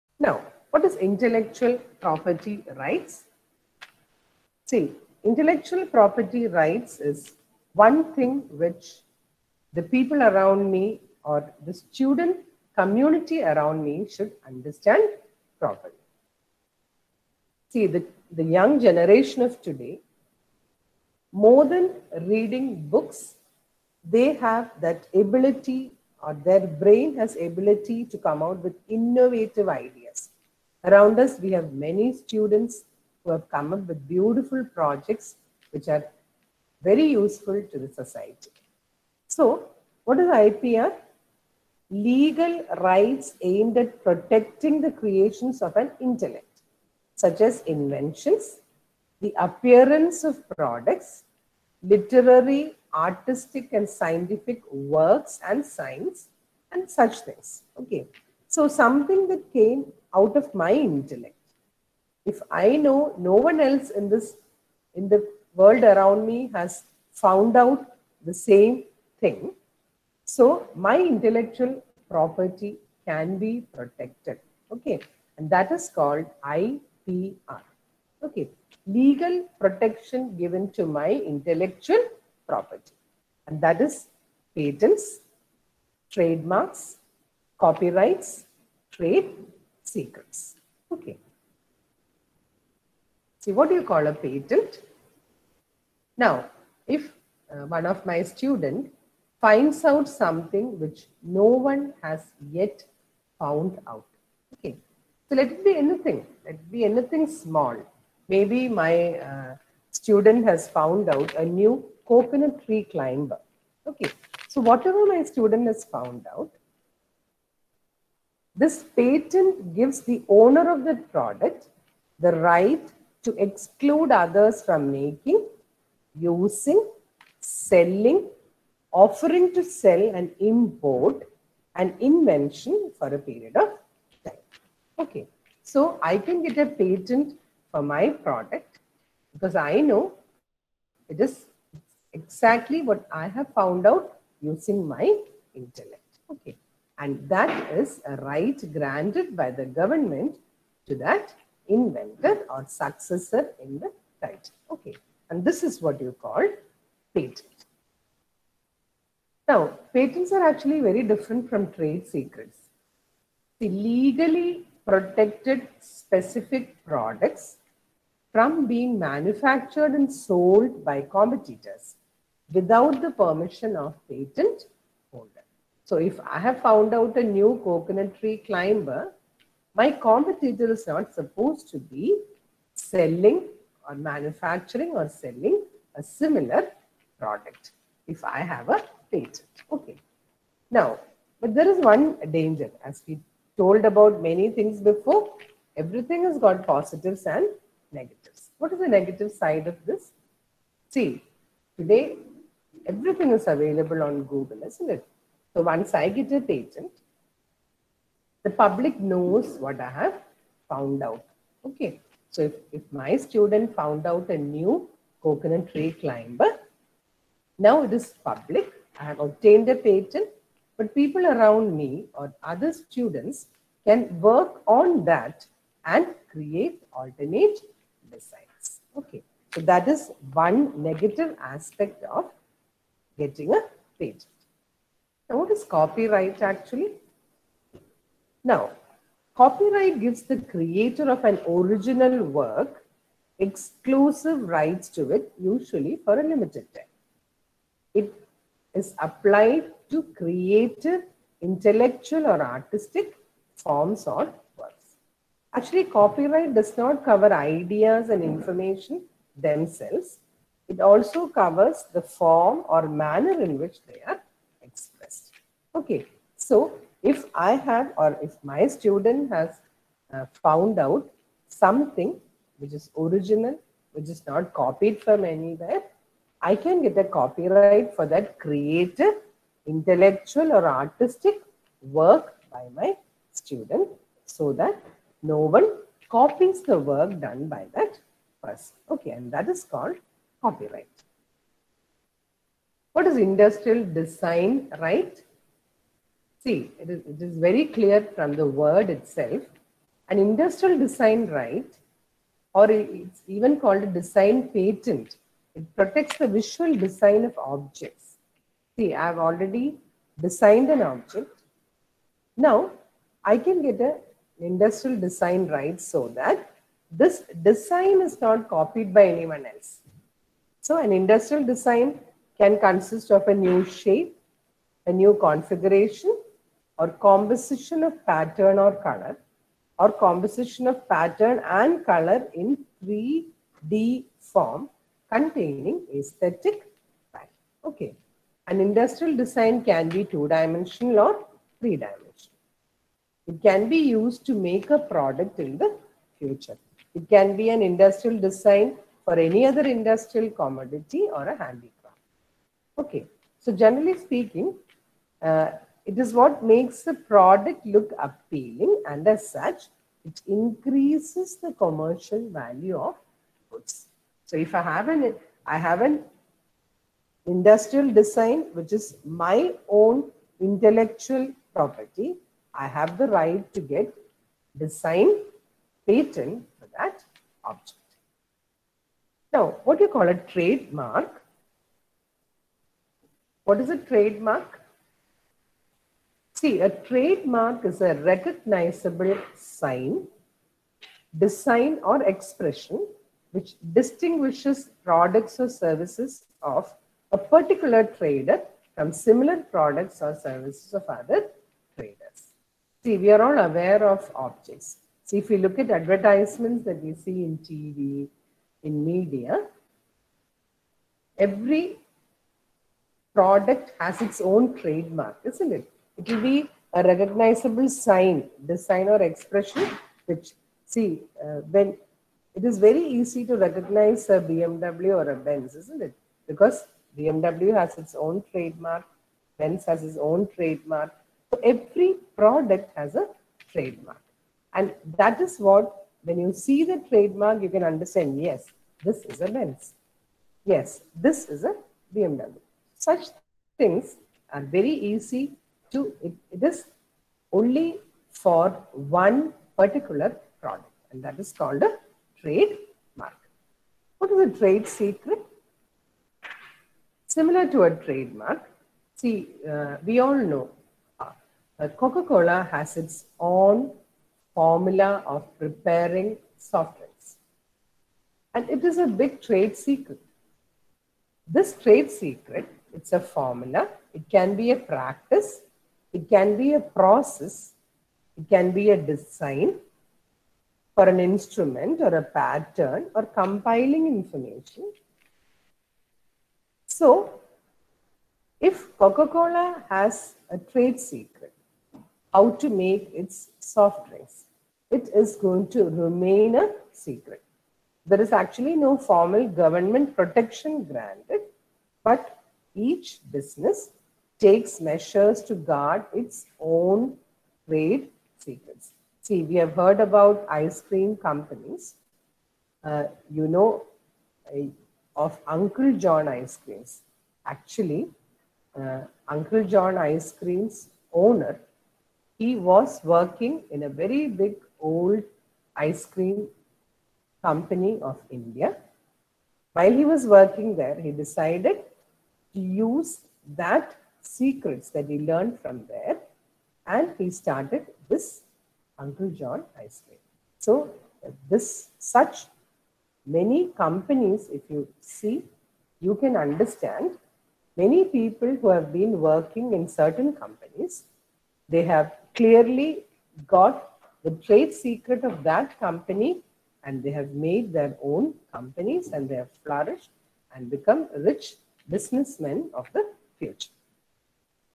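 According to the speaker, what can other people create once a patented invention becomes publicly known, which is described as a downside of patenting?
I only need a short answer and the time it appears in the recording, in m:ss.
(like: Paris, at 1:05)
alternate designs, at 3:46.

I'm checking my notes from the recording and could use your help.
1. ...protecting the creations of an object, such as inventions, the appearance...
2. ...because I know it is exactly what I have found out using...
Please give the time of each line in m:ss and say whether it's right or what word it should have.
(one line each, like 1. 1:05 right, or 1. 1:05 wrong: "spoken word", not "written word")
1. 0:44 wrong: "intellect", not "object"
2. 2:19 right.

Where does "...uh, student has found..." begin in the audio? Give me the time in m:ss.
1:49.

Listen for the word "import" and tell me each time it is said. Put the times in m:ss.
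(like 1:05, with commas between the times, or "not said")
2:10.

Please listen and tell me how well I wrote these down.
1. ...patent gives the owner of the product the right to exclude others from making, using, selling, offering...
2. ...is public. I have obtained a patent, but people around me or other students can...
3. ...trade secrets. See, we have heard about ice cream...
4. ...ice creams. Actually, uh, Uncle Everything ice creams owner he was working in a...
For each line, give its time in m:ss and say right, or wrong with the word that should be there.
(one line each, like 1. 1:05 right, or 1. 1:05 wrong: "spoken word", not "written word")
1. 1:58 right
2. 3:37 right
3. 8:27 right
4. 8:36 wrong: "John", not "Everything".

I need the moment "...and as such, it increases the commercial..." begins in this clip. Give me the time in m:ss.
5:58.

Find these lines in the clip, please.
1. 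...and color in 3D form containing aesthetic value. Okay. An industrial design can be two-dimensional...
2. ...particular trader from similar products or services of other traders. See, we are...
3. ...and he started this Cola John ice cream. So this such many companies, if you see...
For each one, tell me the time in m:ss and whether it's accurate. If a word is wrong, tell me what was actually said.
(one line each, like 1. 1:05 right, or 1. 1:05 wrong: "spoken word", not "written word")
1. 5:31 right
2. 6:37 right
3. 8:56 wrong: "Uncle", not "Cola".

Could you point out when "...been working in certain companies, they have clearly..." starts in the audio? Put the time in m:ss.
9:08.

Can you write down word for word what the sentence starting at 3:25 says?
So once I get a patent, the public knows what I have found out.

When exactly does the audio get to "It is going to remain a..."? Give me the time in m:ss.
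8:14.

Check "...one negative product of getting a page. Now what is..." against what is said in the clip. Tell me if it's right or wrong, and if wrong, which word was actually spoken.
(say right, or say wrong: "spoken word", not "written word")
wrong: "aspect", not "product".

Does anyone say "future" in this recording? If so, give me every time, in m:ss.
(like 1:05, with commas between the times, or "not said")
5:46, 9:23.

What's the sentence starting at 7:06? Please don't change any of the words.
Because BMW has its own trademark, Benz has its own trademark.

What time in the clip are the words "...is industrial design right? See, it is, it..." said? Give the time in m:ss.
4:53.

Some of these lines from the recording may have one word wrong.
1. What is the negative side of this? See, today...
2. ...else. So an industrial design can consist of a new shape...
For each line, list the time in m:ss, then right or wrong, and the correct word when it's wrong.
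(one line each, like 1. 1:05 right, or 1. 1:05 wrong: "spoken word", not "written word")
1. 3:18 right
2. 5:19 right.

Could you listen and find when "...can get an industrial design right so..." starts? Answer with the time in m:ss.
5:13.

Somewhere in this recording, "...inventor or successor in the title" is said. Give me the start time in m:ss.
2:31.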